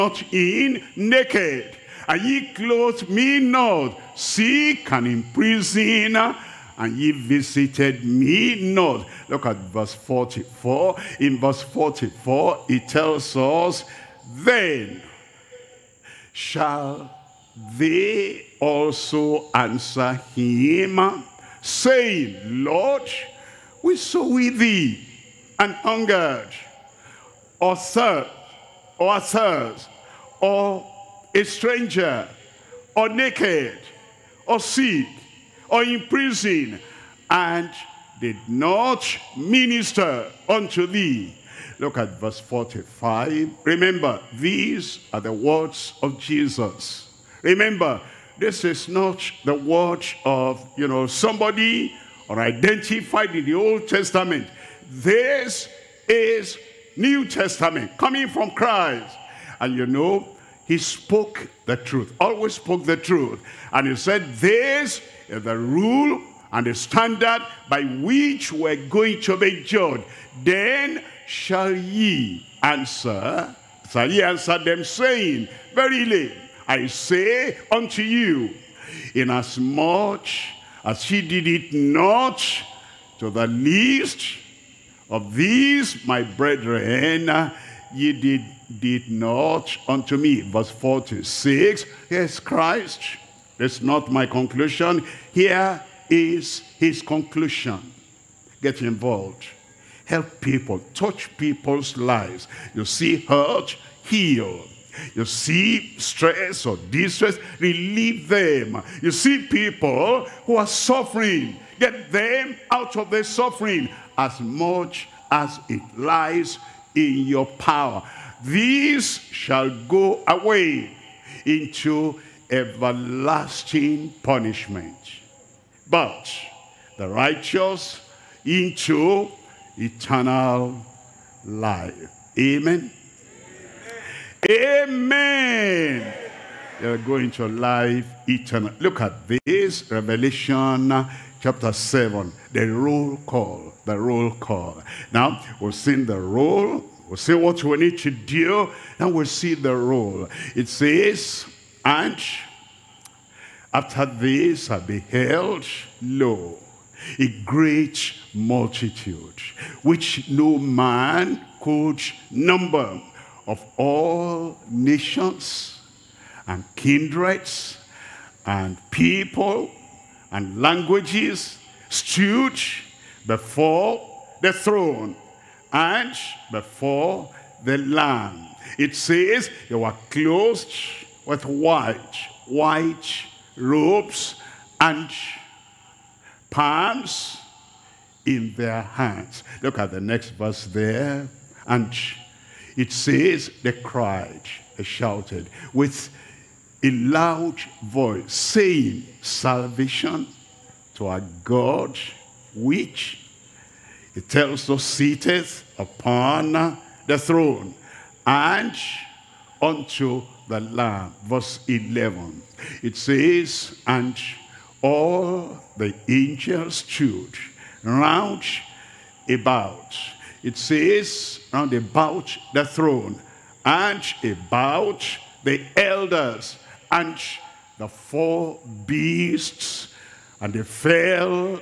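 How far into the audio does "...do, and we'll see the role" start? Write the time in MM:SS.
02:28.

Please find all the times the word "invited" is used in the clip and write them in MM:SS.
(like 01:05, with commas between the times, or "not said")
not said.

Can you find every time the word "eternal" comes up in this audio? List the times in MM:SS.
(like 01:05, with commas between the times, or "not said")
02:09, 02:18.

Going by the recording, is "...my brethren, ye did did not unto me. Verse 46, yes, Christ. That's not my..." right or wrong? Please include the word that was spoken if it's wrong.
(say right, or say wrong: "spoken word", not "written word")
right.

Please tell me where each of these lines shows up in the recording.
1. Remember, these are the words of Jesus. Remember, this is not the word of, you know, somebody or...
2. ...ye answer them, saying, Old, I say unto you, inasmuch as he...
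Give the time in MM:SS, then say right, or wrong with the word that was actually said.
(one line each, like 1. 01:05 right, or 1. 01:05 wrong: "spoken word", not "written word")
1. 00:43 right
2. 01:14 wrong: "Verily", not "Old".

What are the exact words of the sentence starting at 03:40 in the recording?
It says, round about the throne and about the elders and the four beasts.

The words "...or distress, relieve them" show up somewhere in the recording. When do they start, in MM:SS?
01:46.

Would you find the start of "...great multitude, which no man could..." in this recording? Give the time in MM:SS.
02:37.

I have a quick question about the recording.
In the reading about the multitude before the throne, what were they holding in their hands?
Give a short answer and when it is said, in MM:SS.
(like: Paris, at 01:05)
Palms, at 03:06.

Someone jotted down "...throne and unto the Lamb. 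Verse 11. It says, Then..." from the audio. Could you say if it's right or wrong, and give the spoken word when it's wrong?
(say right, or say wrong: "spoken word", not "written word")
wrong: "And", not "Then".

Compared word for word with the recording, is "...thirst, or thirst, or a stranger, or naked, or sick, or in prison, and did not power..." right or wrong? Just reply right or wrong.
wrong.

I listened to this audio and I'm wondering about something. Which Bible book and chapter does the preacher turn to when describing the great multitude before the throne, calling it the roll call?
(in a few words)
Revelation chapter 7.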